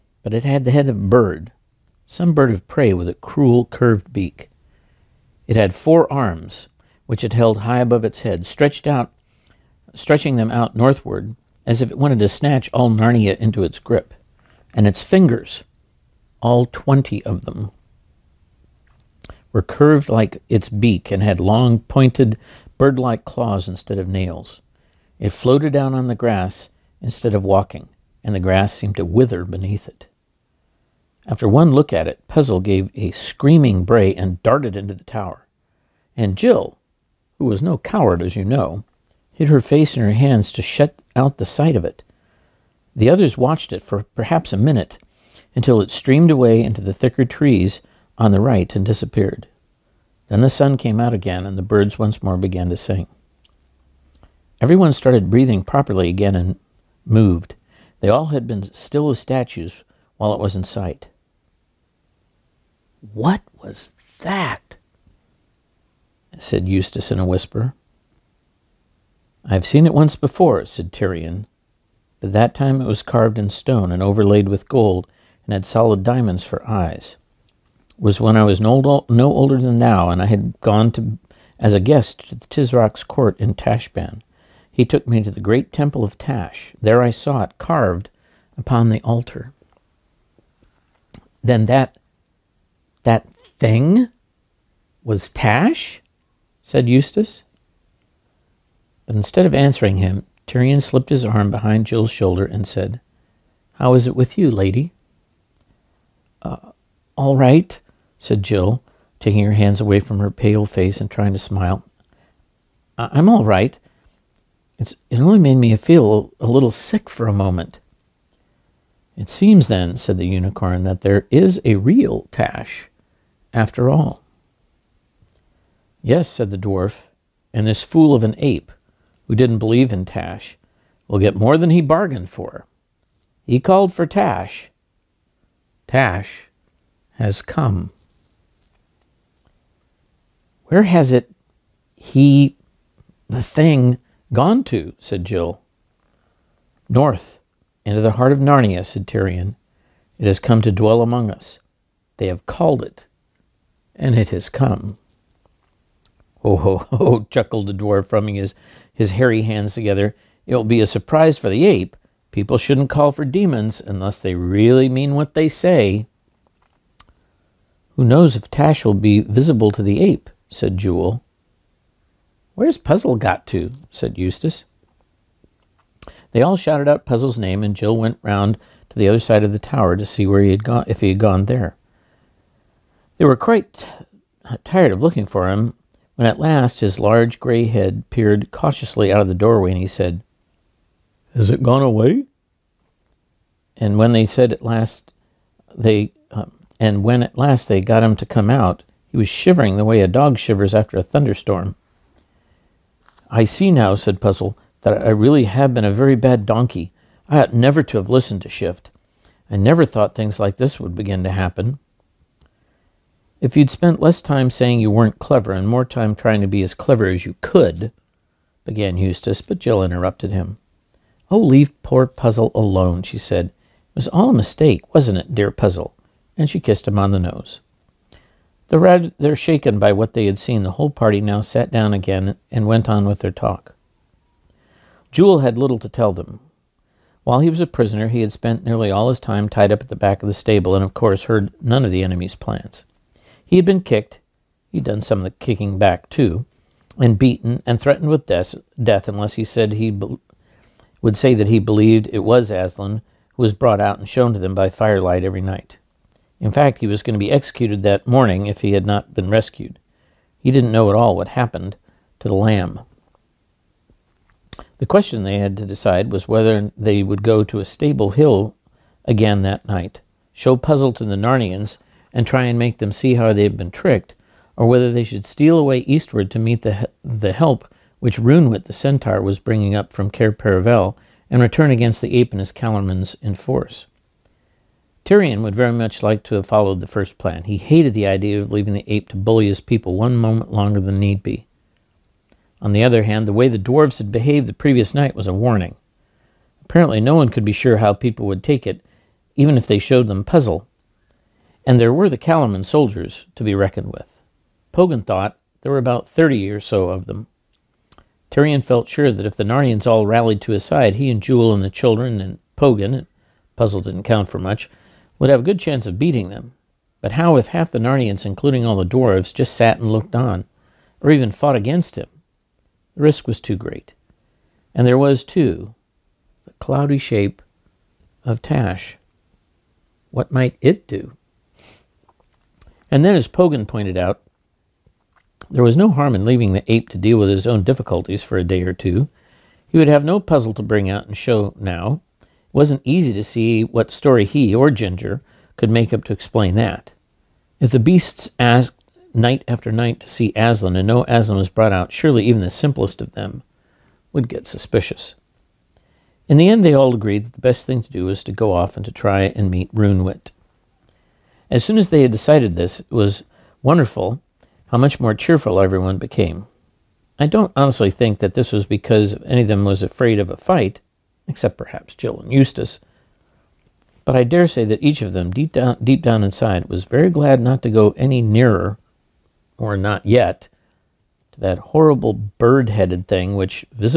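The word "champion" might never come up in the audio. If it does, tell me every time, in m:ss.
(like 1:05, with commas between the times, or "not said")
not said.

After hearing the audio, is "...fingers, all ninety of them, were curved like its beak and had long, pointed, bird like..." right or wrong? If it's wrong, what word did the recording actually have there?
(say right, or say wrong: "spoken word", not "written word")
wrong: "twenty", not "ninety".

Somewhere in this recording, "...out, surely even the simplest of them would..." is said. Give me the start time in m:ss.
5:51.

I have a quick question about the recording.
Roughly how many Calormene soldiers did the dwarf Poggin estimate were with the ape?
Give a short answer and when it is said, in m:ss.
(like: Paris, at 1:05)
30, at 5:06.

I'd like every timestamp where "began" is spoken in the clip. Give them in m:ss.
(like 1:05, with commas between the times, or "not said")
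0:52, 3:38.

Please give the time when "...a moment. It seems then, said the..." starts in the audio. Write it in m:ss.
1:57.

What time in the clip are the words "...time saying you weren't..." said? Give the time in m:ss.
3:34.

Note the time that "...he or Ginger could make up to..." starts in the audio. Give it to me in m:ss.
5:44.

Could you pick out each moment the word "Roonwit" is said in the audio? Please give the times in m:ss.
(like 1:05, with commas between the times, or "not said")
4:38, 5:59.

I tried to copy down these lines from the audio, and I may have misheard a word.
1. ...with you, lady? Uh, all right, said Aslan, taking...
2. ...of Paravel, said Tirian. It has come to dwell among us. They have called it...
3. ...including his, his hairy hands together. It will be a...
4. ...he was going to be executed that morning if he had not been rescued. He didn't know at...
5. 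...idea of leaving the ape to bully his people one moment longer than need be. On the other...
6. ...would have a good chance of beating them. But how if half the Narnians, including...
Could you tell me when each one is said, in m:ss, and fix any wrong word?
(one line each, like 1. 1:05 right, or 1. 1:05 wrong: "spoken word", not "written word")
1. 1:44 wrong: "Jill", not "Aslan"
2. 2:28 wrong: "Narnia", not "Paravel"
3. 2:38 wrong: "rubbing", not "including"
4. 4:16 right
5. 4:48 right
6. 5:15 right.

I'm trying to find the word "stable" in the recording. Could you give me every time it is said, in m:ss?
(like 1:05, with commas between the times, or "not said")
4:00, 4:27.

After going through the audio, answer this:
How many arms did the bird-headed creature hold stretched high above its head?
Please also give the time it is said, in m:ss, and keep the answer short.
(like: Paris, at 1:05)
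4, at 0:05.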